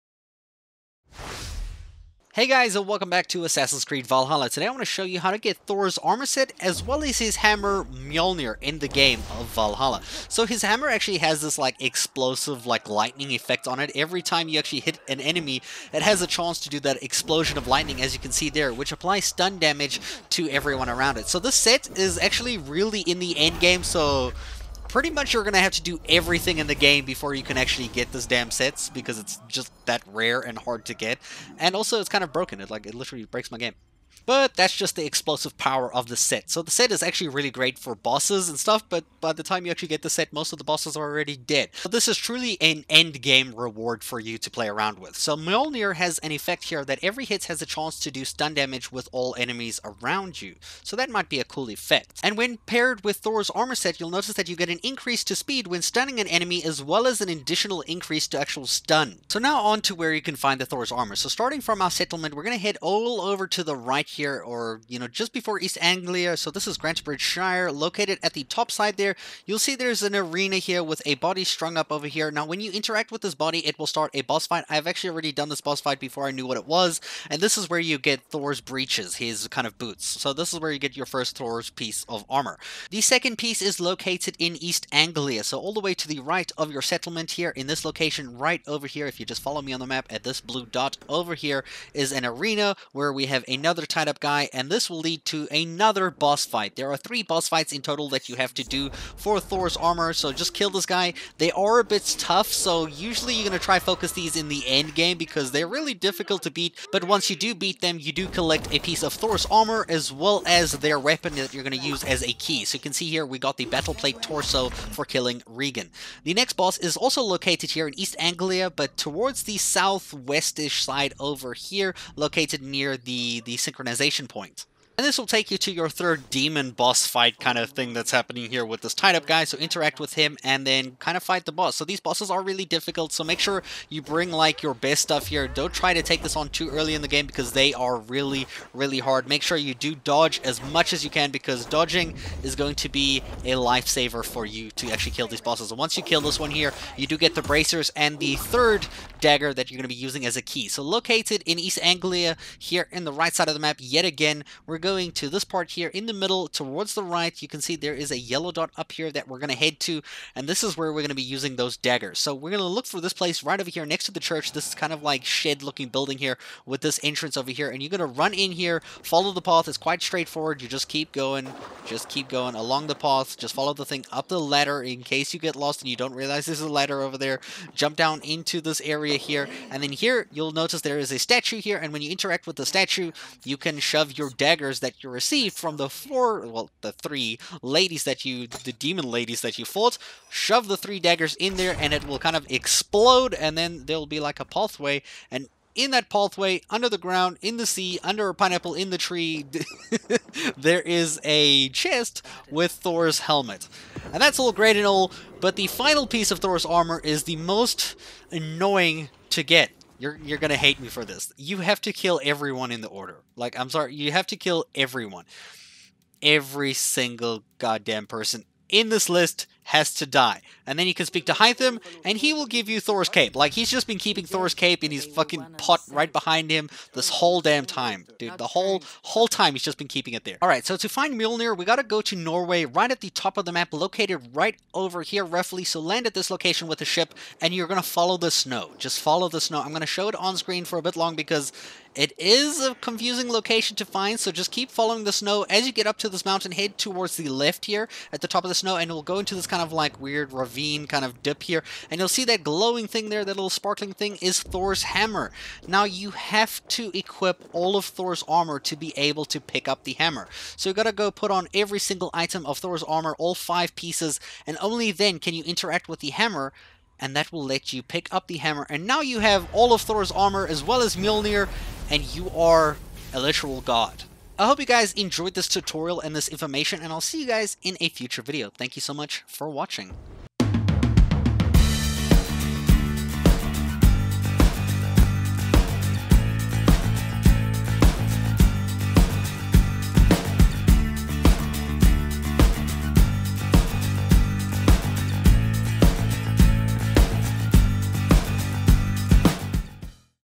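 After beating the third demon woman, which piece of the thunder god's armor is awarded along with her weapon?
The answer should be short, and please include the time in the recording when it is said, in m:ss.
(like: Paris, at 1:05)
bracers, at 2:27.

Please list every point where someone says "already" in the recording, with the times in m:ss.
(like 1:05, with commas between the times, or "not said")
0:41, 1:15.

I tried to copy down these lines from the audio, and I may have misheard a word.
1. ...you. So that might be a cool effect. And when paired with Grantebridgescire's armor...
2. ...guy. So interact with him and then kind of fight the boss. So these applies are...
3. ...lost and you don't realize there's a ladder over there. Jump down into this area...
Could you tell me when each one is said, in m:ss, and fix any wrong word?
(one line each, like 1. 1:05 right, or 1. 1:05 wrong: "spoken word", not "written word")
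1. 0:50 wrong: "Thor", not "Grantebridgescire"
2. 2:09 wrong: "bosses", not "applies"
3. 2:55 right.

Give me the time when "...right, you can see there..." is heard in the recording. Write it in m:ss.
2:37.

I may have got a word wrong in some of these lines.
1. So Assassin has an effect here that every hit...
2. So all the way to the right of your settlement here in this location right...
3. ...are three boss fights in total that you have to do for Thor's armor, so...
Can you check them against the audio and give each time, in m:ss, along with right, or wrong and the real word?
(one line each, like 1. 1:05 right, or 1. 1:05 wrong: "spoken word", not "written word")
1. 0:45 wrong: "Mjolnir", not "Assassin"
2. 1:25 right
3. 1:36 right.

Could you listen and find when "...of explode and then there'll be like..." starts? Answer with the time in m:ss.
3:12.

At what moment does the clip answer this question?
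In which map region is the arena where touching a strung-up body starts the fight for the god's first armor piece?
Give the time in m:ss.
1:06.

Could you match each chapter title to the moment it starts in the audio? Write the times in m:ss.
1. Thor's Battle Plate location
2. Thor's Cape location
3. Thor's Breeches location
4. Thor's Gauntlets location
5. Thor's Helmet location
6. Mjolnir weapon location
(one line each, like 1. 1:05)
1. 1:23
2. 3:25
3. 0:59
4. 1:56
5. 2:31
6. 3:49.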